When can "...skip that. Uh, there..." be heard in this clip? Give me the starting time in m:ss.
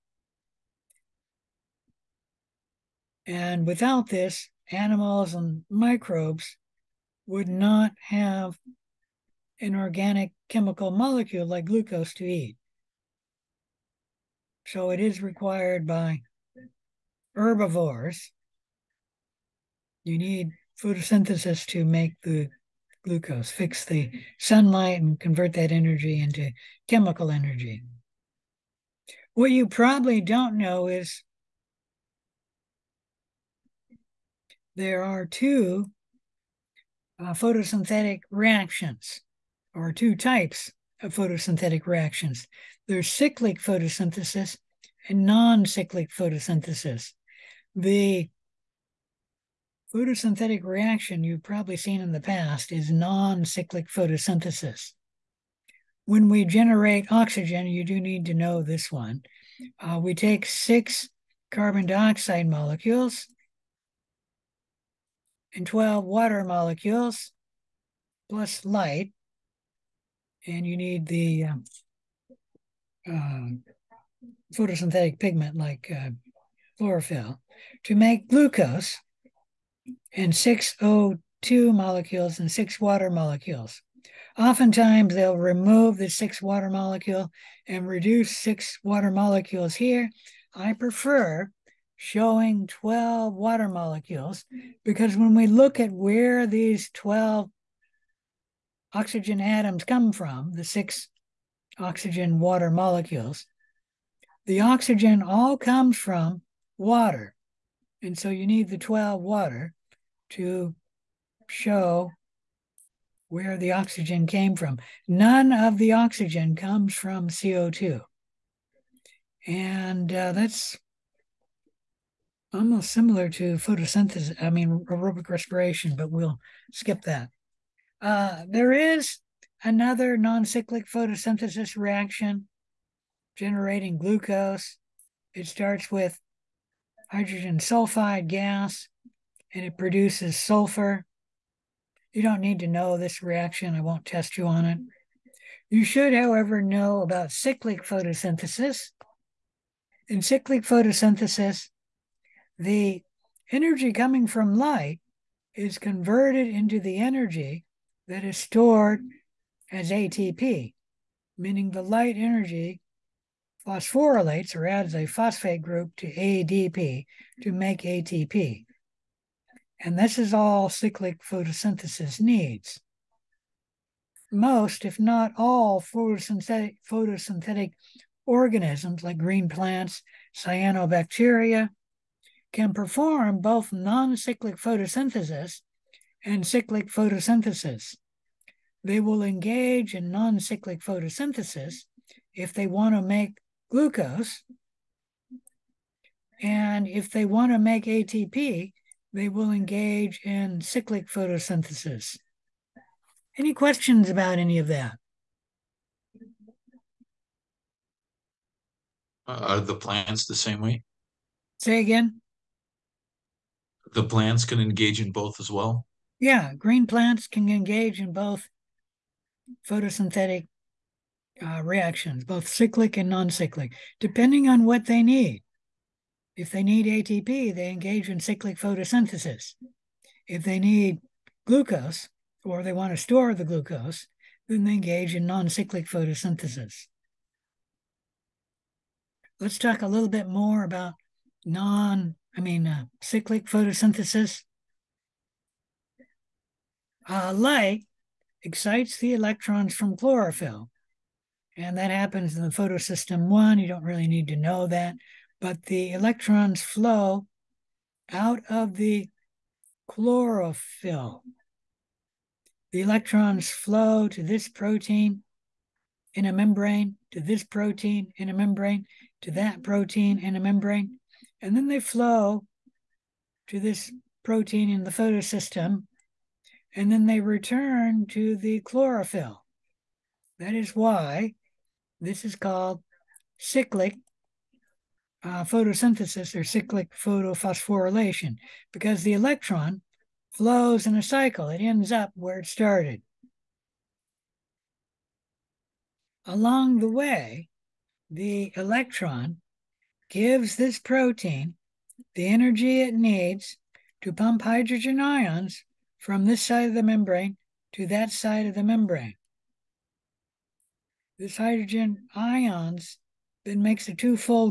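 2:06.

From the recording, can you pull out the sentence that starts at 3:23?
Any questions about any of that?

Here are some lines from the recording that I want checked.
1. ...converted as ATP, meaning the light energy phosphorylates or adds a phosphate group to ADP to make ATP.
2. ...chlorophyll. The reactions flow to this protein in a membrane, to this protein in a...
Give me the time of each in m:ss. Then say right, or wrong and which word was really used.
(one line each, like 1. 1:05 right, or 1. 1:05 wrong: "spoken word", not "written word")
1. 2:38 wrong: "stored", not "converted"
2. 4:19 wrong: "electrons", not "reactions".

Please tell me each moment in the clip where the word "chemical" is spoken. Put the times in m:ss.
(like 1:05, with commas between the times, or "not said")
0:10, 0:26.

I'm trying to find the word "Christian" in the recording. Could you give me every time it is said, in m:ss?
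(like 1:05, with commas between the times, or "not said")
not said.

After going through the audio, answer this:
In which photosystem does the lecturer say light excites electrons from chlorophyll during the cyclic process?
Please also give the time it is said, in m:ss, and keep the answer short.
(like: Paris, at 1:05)
photosystem one, at 4:12.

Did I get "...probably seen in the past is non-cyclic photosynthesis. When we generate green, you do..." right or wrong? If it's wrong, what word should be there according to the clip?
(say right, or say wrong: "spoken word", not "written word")
wrong: "oxygen", not "green".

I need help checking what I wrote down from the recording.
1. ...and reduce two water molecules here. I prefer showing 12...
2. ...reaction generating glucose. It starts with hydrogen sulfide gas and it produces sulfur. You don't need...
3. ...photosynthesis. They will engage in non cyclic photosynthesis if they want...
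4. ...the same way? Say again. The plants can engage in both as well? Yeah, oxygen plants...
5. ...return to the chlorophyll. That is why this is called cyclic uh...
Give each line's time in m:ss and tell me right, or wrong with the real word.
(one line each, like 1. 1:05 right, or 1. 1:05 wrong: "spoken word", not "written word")
1. 1:27 wrong: "six", not "two"
2. 2:11 right
3. 3:06 right
4. 3:30 wrong: "green", not "oxygen"
5. 4:37 right.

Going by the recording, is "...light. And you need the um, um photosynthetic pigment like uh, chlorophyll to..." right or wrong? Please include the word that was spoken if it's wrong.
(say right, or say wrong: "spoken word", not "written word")
right.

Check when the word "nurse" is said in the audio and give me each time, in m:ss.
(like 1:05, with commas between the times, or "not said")
not said.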